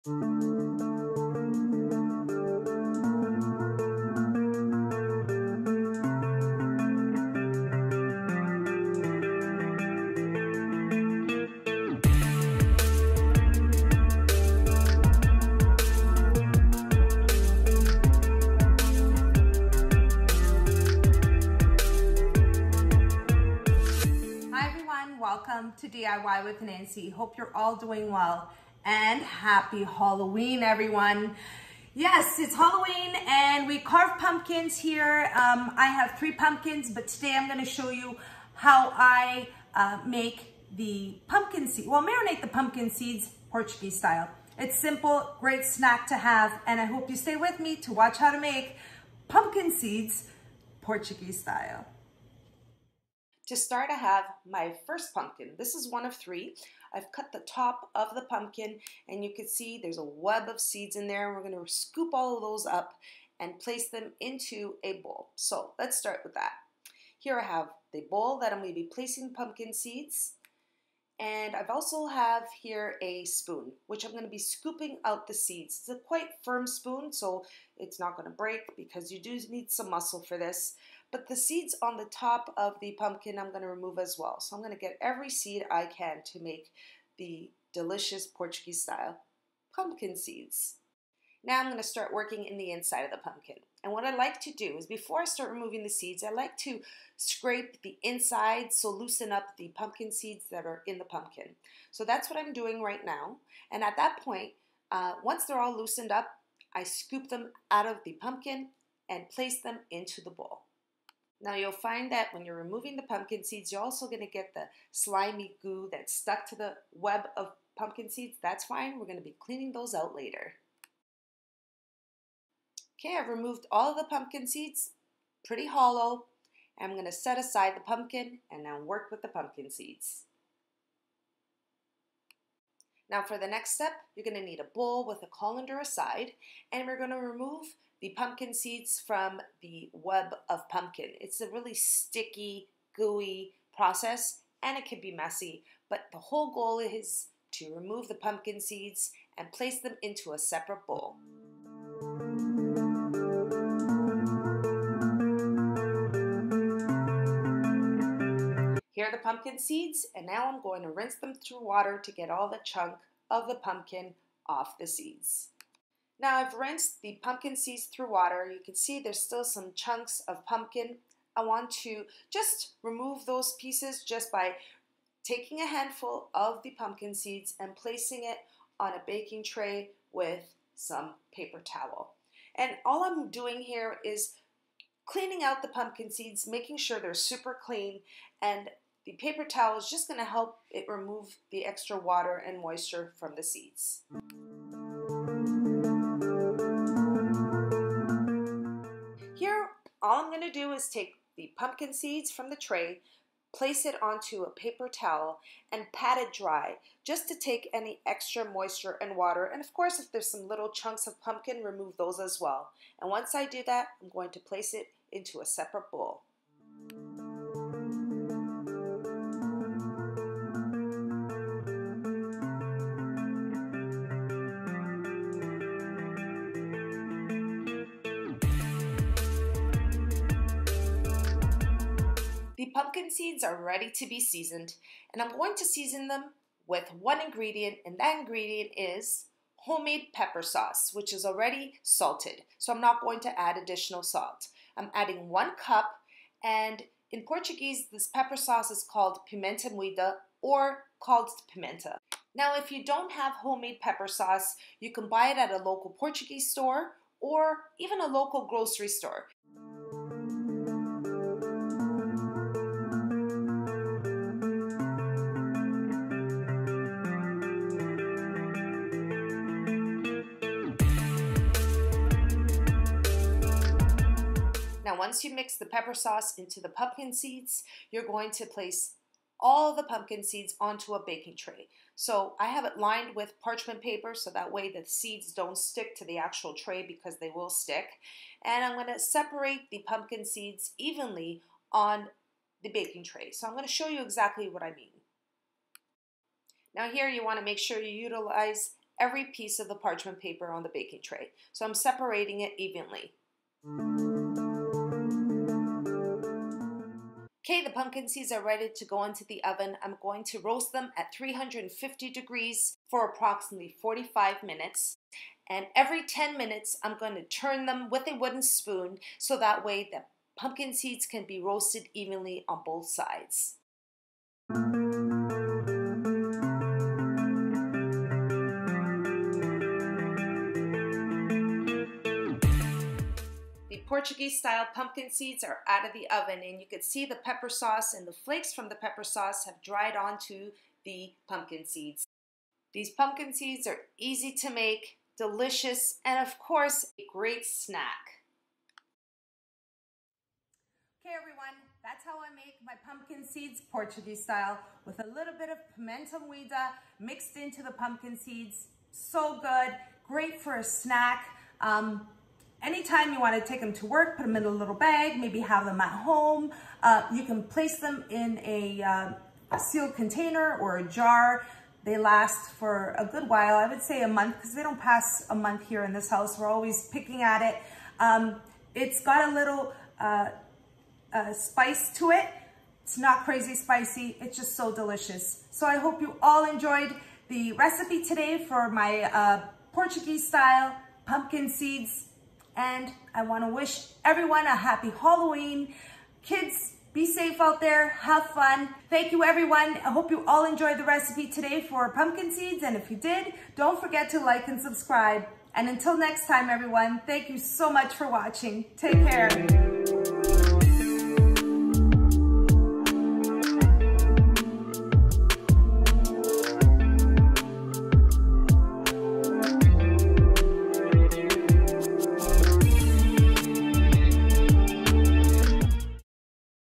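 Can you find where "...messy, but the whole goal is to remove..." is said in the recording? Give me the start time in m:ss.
2:25.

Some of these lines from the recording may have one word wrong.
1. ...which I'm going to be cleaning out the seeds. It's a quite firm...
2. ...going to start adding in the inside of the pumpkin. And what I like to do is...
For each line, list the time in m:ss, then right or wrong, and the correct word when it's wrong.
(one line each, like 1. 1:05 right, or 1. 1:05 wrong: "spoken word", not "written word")
1. 1:13 wrong: "scooping", not "cleaning"
2. 1:31 wrong: "working", not "adding".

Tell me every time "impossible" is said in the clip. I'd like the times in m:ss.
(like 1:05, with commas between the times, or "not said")
not said.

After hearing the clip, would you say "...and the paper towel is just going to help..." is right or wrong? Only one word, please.
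right.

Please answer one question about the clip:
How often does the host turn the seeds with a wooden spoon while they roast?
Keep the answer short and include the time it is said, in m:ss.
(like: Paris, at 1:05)
every 10 minutes, at 5:15.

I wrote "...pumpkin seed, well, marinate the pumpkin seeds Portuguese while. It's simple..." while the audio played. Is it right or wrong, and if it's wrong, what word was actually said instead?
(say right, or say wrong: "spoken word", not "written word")
wrong: "style", not "while".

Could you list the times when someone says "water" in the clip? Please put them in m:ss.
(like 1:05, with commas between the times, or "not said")
2:41, 2:48, 3:11, 3:29.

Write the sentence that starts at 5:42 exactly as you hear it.
These pumpkin seeds are easy to make, delicious, and of course, a great snack.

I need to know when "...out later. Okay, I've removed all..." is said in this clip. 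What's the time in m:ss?
1:59.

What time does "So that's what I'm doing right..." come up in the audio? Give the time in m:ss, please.
1:41.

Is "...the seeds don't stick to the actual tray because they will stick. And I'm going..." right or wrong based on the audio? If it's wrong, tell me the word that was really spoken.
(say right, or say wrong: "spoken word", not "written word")
right.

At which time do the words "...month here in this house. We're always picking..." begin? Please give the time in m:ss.
6:15.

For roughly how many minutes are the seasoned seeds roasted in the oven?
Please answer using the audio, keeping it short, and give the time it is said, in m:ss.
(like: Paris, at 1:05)
45 minutes, at 5:13.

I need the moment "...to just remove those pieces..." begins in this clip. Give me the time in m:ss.
2:51.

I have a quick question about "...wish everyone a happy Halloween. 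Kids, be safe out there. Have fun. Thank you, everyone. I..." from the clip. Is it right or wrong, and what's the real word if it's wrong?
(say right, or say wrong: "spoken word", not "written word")
right.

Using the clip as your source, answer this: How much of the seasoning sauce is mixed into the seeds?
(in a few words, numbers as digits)
1 cup.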